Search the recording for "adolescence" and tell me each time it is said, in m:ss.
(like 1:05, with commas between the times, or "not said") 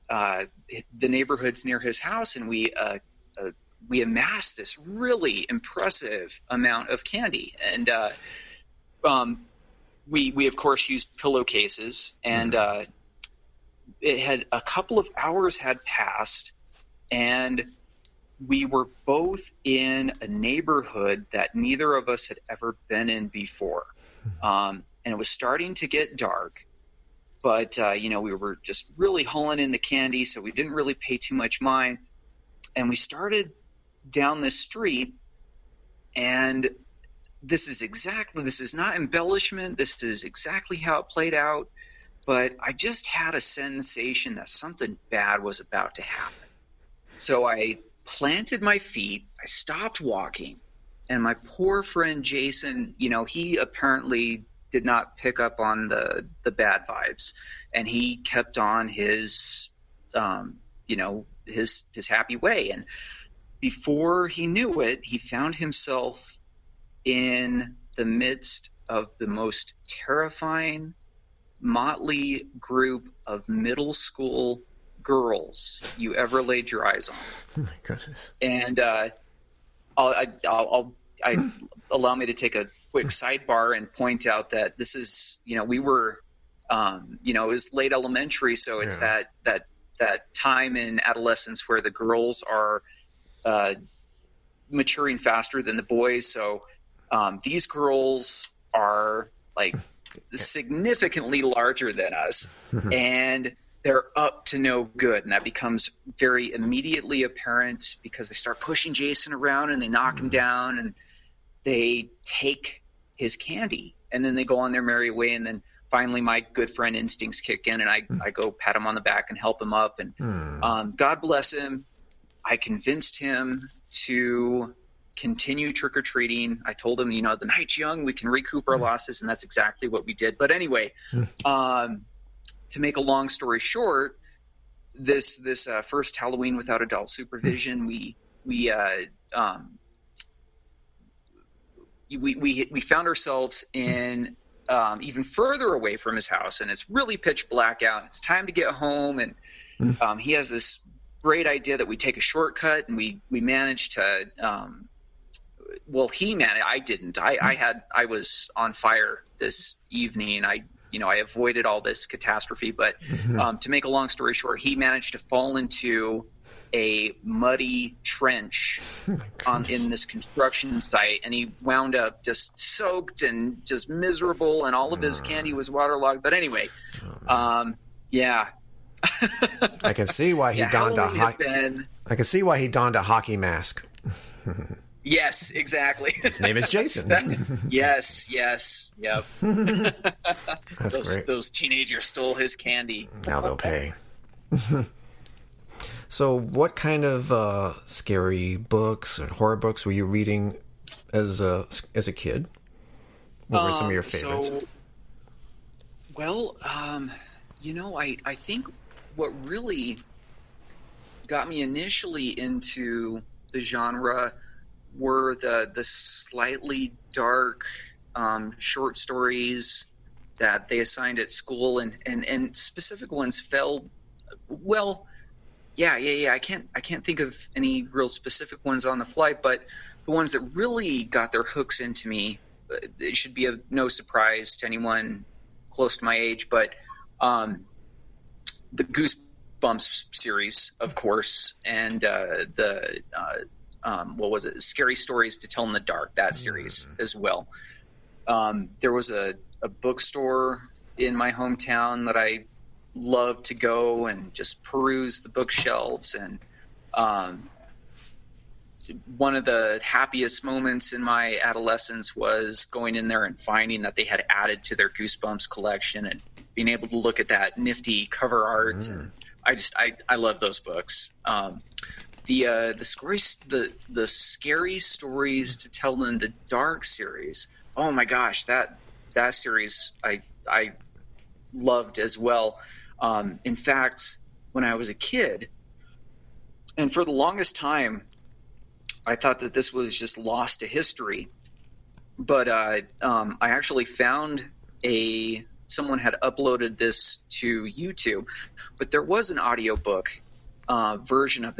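1:31, 4:21.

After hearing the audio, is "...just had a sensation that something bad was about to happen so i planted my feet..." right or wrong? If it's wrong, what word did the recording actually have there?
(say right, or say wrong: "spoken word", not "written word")
right.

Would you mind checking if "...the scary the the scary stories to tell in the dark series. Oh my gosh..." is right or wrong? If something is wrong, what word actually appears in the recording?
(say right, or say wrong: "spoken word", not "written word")
right.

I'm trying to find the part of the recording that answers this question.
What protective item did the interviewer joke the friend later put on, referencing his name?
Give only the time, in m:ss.
3:03.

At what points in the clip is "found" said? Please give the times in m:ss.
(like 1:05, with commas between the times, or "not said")
1:05, 2:22, 4:53.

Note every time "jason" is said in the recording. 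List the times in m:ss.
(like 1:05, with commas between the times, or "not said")
0:52, 1:48, 3:06.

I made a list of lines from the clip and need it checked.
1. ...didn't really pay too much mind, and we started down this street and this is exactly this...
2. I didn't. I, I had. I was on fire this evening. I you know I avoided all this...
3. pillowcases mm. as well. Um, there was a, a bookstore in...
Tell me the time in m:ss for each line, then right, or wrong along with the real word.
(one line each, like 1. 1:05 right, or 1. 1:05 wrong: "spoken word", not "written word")
1. 0:30 right
2. 2:36 right
3. 4:06 wrong: "series", not "pillowcases".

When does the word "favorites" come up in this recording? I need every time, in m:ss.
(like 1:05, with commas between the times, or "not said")
3:24.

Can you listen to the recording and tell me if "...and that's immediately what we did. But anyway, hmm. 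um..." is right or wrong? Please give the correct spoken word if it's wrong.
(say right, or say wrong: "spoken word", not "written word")
wrong: "exactly", not "immediately".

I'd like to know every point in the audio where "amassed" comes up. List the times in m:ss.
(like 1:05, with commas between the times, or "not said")
0:04.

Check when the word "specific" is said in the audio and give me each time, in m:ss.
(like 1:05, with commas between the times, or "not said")
3:42, 3:48.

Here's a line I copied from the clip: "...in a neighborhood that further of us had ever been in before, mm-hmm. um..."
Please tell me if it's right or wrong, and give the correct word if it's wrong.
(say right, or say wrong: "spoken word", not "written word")
wrong: "neither", not "further".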